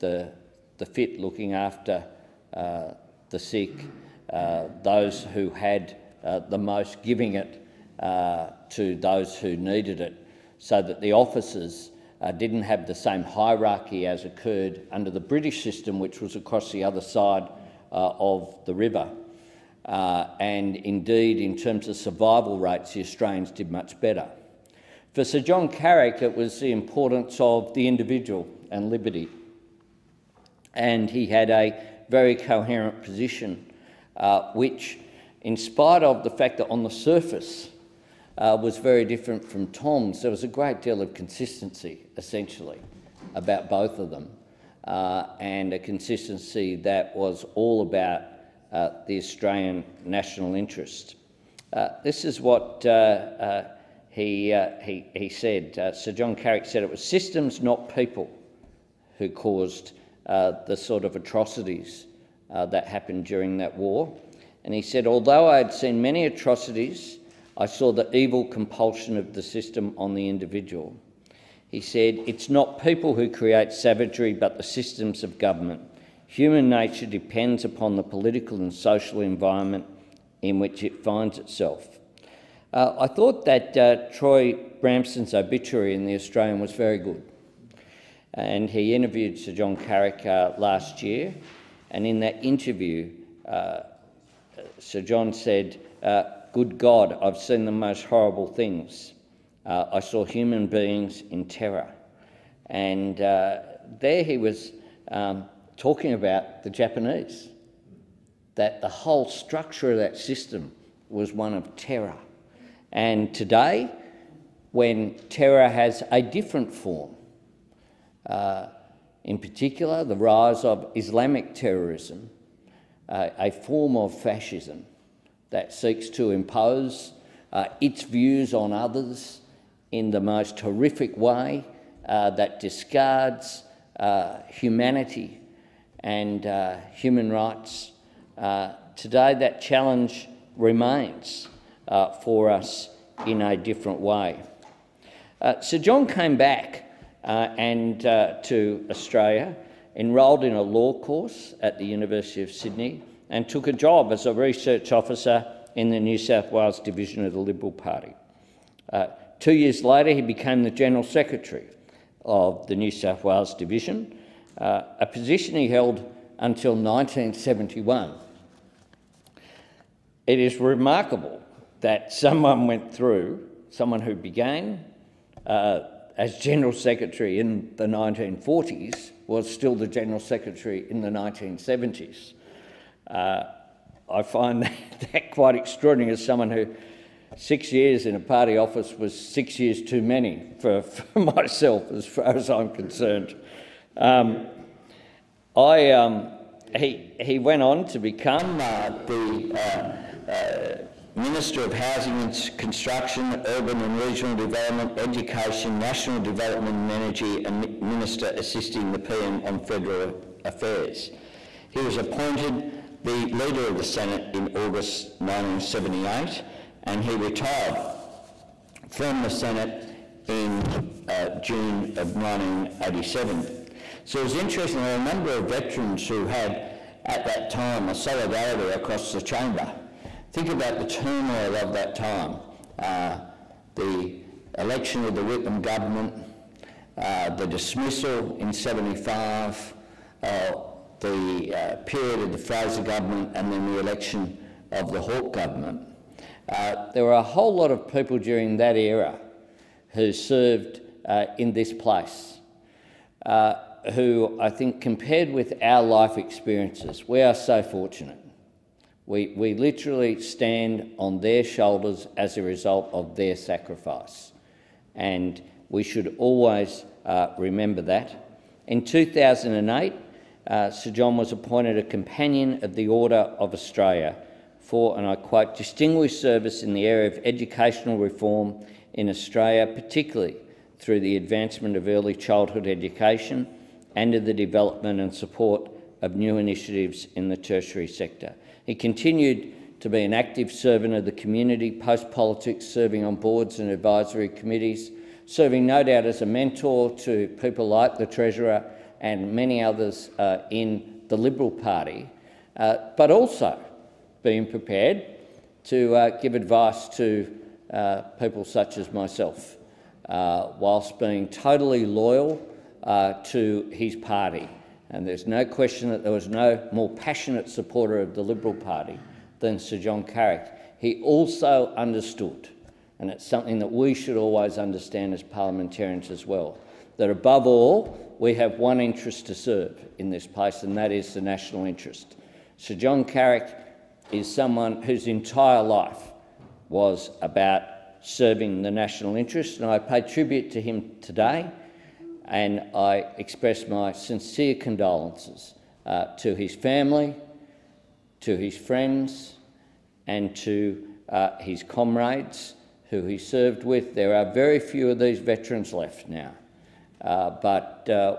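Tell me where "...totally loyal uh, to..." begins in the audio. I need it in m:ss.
5:11.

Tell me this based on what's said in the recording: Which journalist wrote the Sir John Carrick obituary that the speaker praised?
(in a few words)
Troy Bramston.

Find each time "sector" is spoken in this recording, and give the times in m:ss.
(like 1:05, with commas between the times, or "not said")
4:47.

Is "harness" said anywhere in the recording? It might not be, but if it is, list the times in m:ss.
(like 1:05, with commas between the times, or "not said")
not said.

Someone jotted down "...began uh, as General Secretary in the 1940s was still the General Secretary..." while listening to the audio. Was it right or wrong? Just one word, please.
right.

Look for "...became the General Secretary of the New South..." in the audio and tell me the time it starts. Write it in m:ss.
2:40.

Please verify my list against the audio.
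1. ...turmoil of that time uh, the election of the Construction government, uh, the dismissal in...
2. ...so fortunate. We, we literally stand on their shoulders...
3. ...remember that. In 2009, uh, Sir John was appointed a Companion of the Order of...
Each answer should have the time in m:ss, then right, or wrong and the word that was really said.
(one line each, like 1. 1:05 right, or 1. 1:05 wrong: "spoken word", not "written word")
1. 3:50 wrong: "Whitlam", not "Construction"
2. 4:17 right
3. 4:27 wrong: "2008", not "2009".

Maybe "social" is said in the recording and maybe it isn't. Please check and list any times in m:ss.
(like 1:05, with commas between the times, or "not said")
1:18.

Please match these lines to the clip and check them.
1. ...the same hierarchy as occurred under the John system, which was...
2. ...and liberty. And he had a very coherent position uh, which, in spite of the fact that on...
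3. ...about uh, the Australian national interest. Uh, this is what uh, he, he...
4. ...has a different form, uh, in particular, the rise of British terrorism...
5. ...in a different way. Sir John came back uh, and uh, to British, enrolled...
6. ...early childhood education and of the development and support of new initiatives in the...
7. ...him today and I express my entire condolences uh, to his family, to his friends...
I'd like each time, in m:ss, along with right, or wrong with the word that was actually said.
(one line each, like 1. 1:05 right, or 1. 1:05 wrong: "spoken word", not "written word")
1. 0:12 wrong: "British", not "John"
2. 0:28 right
3. 0:47 right
4. 1:55 wrong: "Islamic", not "British"
5. 2:23 wrong: "Australia", not "British"
6. 4:41 right
7. 5:40 wrong: "sincere", not "entire".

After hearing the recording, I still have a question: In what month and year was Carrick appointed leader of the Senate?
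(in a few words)
August 1978.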